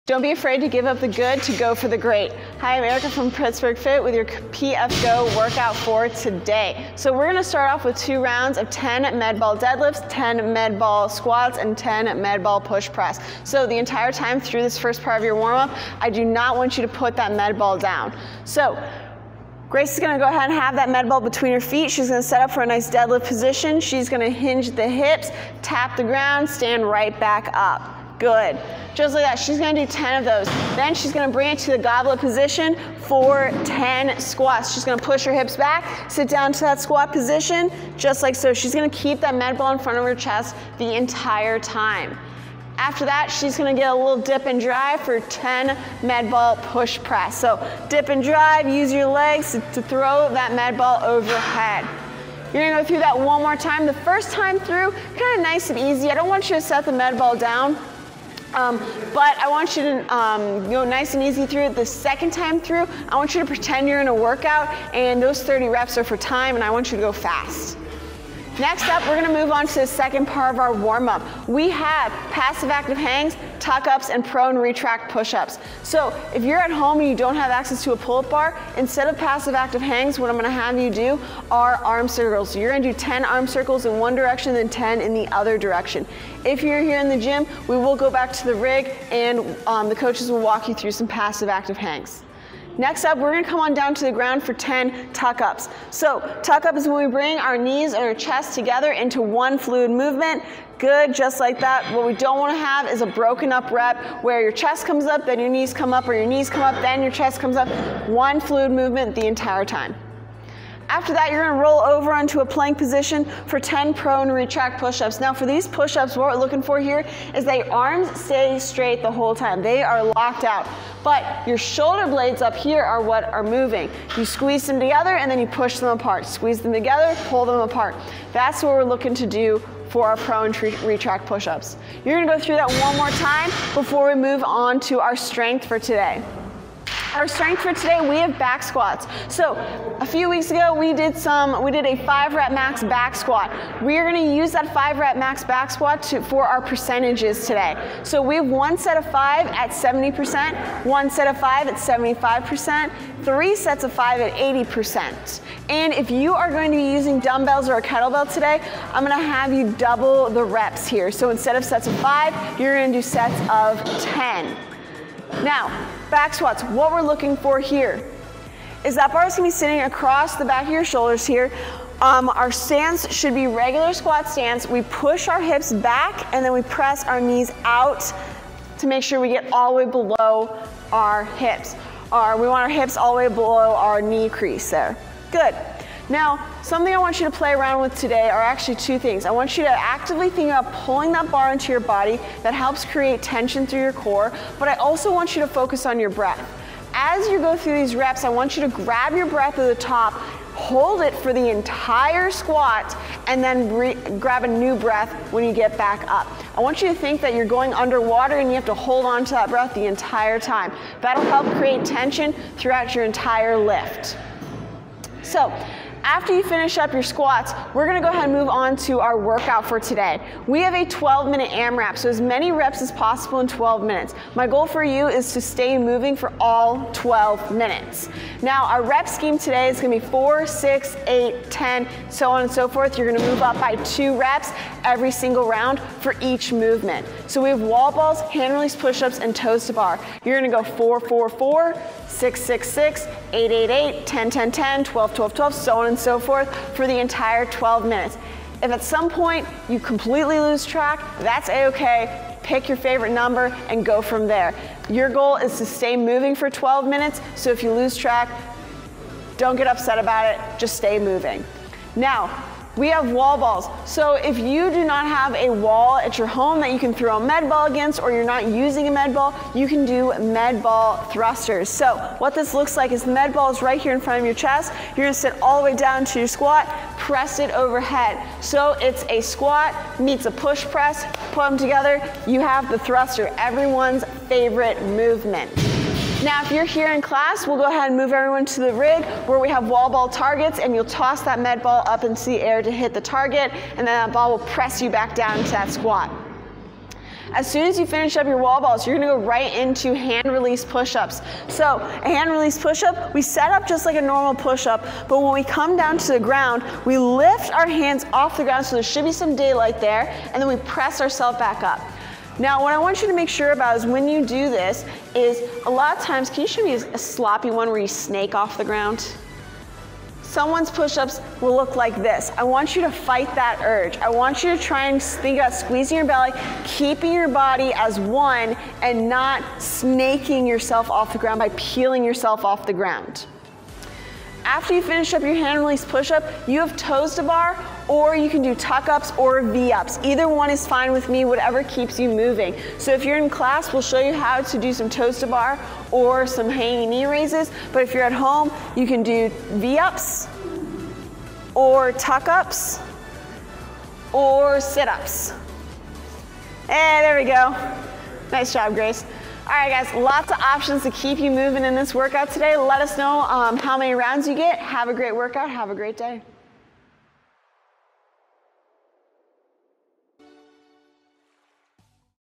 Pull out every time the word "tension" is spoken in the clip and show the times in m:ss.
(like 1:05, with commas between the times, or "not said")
3:13, 3:31.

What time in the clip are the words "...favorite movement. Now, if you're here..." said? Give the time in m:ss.
4:44.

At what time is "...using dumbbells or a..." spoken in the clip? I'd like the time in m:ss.
2:36.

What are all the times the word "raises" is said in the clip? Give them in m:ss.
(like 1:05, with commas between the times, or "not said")
5:47.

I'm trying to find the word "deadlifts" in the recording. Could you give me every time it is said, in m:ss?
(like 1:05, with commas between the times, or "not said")
0:09, 0:22.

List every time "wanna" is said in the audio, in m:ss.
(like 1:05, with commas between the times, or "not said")
1:42.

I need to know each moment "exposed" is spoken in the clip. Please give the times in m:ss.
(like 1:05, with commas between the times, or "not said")
not said.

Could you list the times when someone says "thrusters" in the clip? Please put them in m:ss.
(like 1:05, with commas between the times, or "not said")
4:31, 4:42.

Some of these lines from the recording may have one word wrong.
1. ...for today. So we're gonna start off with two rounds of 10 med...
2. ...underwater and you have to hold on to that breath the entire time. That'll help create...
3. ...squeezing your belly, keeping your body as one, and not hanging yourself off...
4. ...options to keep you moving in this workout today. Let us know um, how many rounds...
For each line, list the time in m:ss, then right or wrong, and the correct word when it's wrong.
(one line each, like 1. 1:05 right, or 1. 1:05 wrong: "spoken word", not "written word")
1. 0:05 right
2. 3:27 right
3. 5:25 wrong: "snaking", not "hanging"
4. 6:00 right.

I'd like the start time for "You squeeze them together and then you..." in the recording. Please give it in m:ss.
2:04.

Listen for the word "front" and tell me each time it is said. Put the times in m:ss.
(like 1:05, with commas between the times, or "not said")
0:39, 4:34.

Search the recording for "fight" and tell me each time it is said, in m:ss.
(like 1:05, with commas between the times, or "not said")
5:22.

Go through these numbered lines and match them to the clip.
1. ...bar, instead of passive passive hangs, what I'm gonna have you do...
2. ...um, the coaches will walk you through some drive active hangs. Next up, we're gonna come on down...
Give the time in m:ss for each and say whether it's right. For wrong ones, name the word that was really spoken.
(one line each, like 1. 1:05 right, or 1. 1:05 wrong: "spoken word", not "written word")
1. 1:18 wrong: "active", not "passive"
2. 1:29 wrong: "passive", not "drive".